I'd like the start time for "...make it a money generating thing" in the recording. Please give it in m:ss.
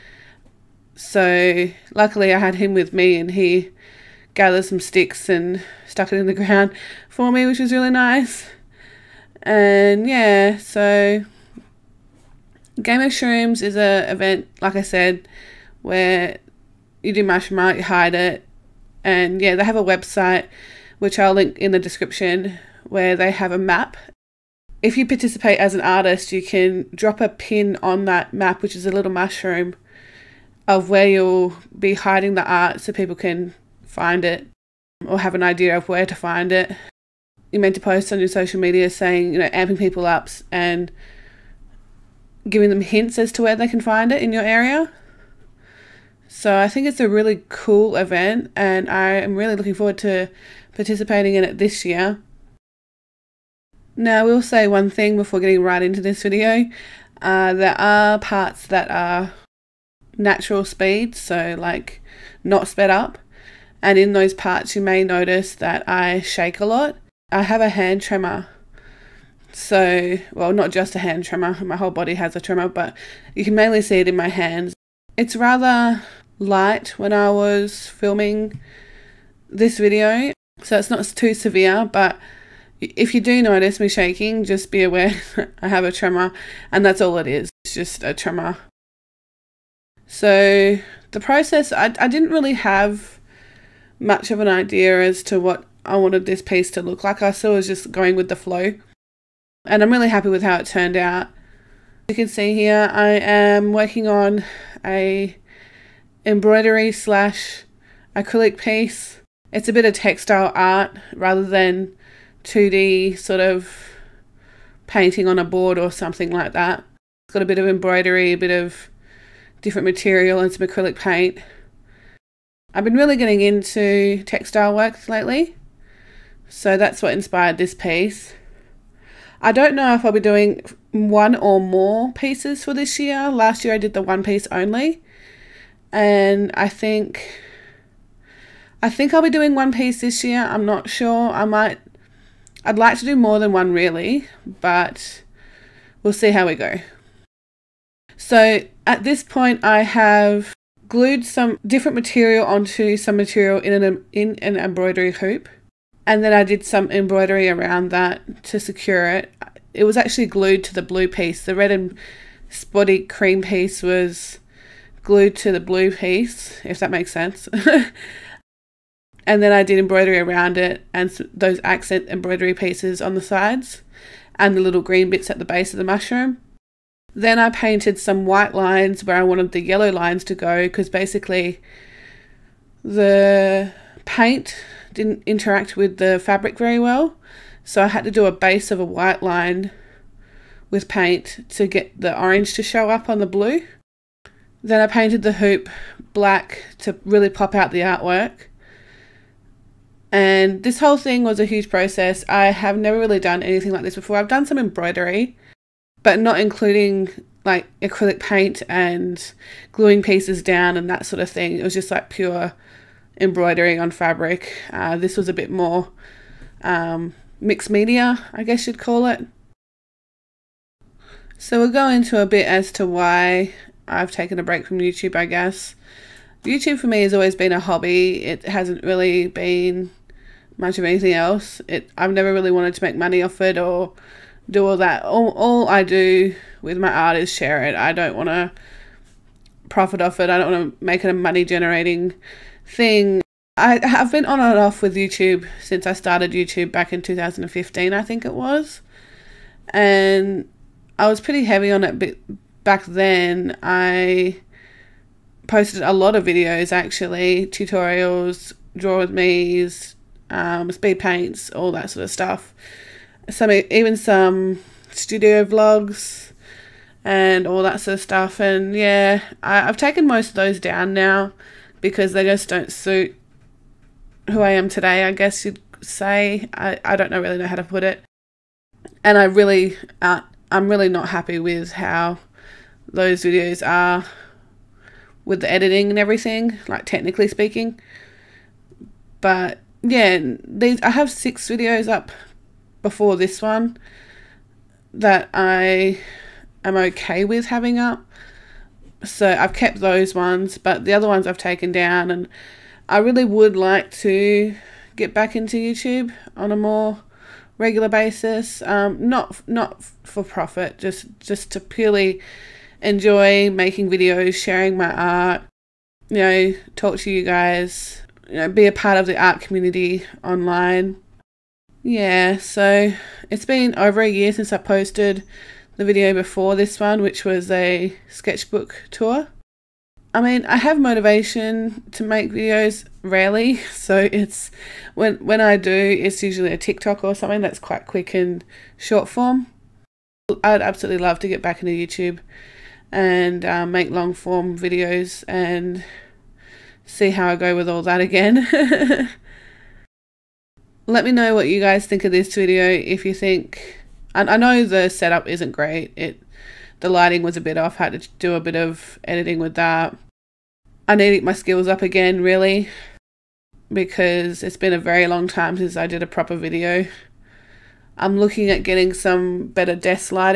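4:00.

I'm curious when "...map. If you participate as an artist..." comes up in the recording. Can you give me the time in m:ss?
0:23.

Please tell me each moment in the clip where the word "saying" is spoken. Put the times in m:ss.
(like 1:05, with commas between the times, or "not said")
0:38.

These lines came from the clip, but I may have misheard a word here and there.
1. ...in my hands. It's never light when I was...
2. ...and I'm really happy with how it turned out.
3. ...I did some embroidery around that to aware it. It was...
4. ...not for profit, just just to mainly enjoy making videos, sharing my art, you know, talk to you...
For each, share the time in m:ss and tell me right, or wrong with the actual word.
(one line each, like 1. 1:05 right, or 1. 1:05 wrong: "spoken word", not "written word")
1. 1:14 wrong: "rather", not "never"
2. 1:39 right
3. 2:36 wrong: "secure", not "aware"
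4. 5:09 wrong: "purely", not "mainly".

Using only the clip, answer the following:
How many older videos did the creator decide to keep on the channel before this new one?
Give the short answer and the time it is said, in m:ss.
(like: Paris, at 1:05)
6, at 4:51.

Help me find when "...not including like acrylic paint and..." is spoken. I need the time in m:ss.
3:26.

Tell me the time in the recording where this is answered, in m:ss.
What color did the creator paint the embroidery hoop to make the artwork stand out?
3:16.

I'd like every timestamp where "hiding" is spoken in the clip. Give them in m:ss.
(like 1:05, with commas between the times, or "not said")
0:31.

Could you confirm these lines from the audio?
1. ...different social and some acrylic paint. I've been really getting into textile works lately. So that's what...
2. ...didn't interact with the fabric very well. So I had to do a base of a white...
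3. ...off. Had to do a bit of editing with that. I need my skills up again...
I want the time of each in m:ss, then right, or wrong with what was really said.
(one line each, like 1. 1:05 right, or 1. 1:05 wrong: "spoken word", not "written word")
1. 1:59 wrong: "material", not "social"
2. 3:04 right
3. 5:57 right.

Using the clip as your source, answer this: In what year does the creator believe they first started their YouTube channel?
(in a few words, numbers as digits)
2015.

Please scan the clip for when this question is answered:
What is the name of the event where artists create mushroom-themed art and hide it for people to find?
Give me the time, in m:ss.
0:12.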